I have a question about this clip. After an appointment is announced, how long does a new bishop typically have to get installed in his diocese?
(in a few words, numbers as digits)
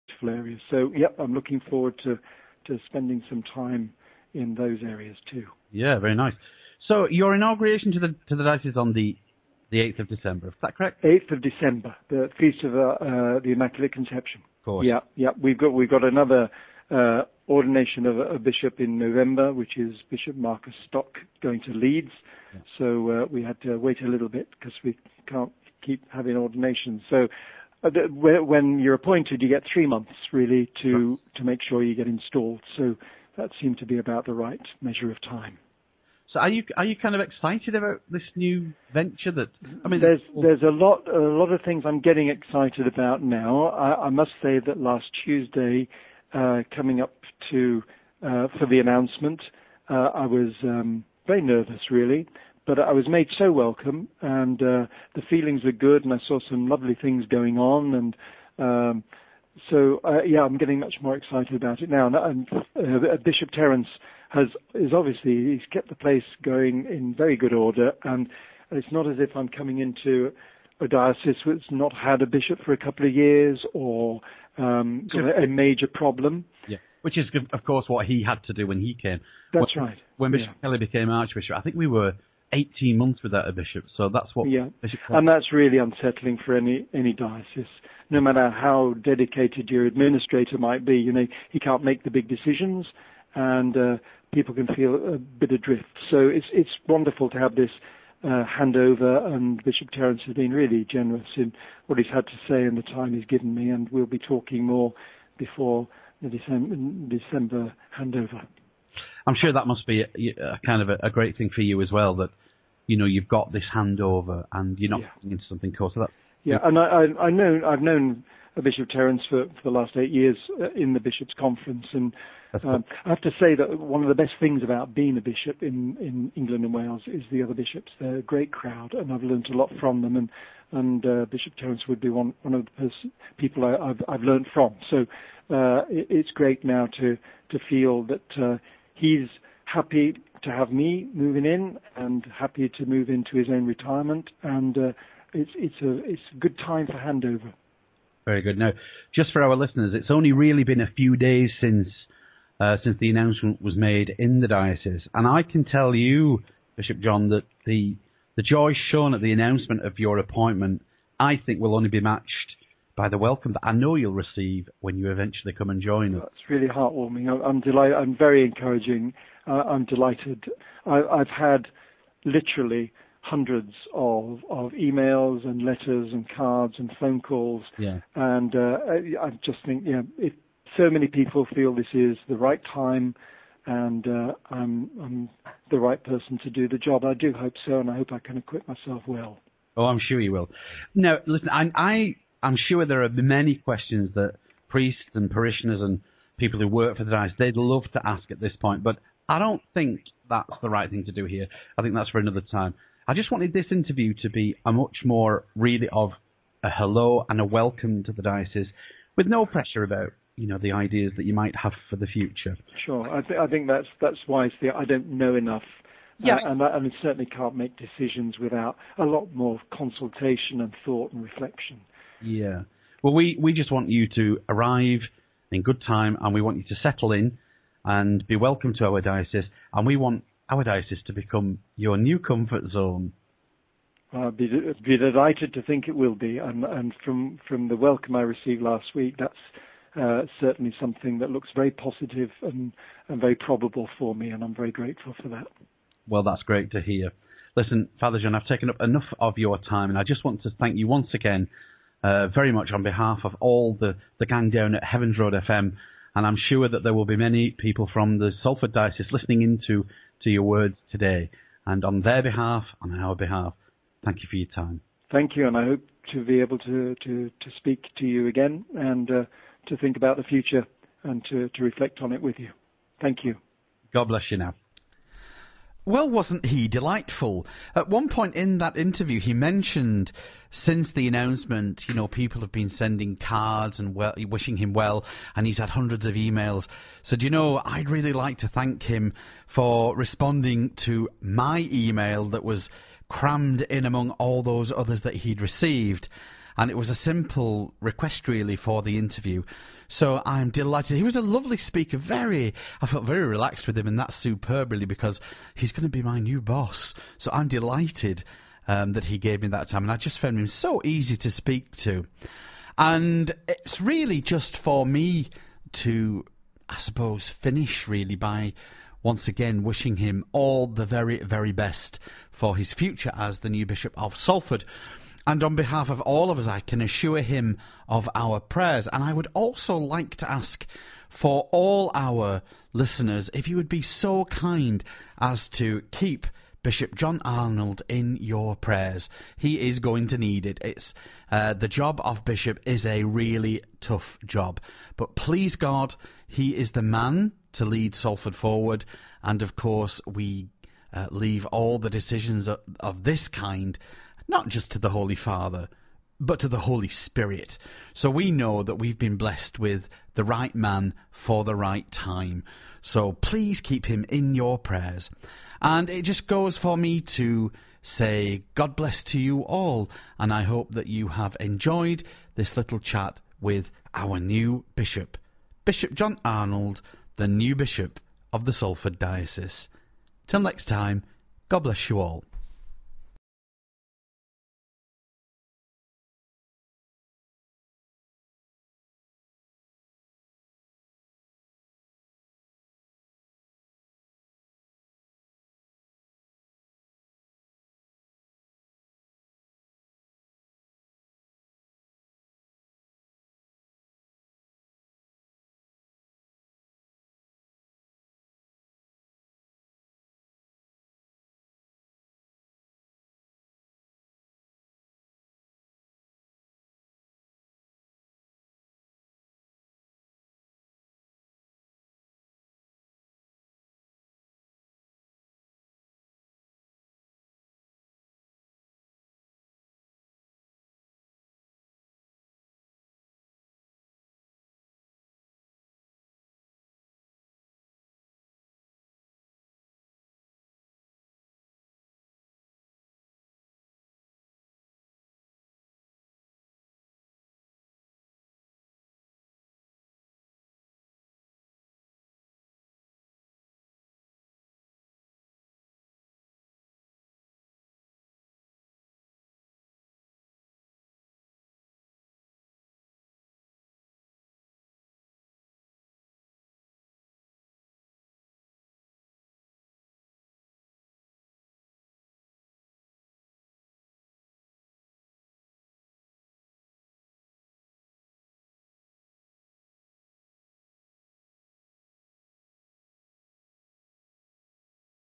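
3 months.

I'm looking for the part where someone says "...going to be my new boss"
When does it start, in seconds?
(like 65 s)
305 s.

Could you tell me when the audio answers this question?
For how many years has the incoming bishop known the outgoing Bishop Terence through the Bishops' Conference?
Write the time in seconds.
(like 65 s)
119 s.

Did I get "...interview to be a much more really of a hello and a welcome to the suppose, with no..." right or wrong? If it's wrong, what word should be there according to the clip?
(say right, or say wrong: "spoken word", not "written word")
wrong: "diocese", not "suppose".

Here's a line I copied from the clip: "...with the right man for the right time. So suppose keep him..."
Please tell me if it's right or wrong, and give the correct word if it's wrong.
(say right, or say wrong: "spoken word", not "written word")
wrong: "please", not "suppose".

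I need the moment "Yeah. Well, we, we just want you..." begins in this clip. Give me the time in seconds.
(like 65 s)
222 s.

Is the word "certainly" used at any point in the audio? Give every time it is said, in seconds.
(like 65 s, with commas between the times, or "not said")
217 s, 240 s.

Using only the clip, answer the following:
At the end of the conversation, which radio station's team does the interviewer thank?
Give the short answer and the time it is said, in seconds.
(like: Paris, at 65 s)
Heavens Road FM, at 254 s.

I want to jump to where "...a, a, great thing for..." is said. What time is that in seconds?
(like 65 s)
110 s.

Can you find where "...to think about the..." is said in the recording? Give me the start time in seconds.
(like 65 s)
269 s.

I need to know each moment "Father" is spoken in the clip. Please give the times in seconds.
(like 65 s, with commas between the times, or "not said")
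247 s, 355 s.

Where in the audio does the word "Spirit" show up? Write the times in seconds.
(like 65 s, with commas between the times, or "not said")
356 s.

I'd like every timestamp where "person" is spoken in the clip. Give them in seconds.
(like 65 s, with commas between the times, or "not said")
186 s.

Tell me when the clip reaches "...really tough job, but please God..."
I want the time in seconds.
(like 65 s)
343 s.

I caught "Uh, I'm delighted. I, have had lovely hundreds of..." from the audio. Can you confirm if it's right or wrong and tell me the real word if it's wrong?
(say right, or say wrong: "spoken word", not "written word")
wrong: "literally", not "lovely".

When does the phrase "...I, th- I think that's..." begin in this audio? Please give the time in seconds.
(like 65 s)
213 s.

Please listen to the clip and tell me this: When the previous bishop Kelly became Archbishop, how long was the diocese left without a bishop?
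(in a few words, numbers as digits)
18 months.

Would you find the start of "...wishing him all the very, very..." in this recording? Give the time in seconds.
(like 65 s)
319 s.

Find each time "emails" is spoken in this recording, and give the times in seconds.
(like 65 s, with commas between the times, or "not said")
174 s, 286 s, 291 s.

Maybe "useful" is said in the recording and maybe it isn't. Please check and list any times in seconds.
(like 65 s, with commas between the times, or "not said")
0 s.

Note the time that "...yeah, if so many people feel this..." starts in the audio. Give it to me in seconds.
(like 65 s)
179 s.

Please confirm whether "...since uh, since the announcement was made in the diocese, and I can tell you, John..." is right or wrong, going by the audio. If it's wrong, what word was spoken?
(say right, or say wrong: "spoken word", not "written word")
wrong: "Bishop", not "John".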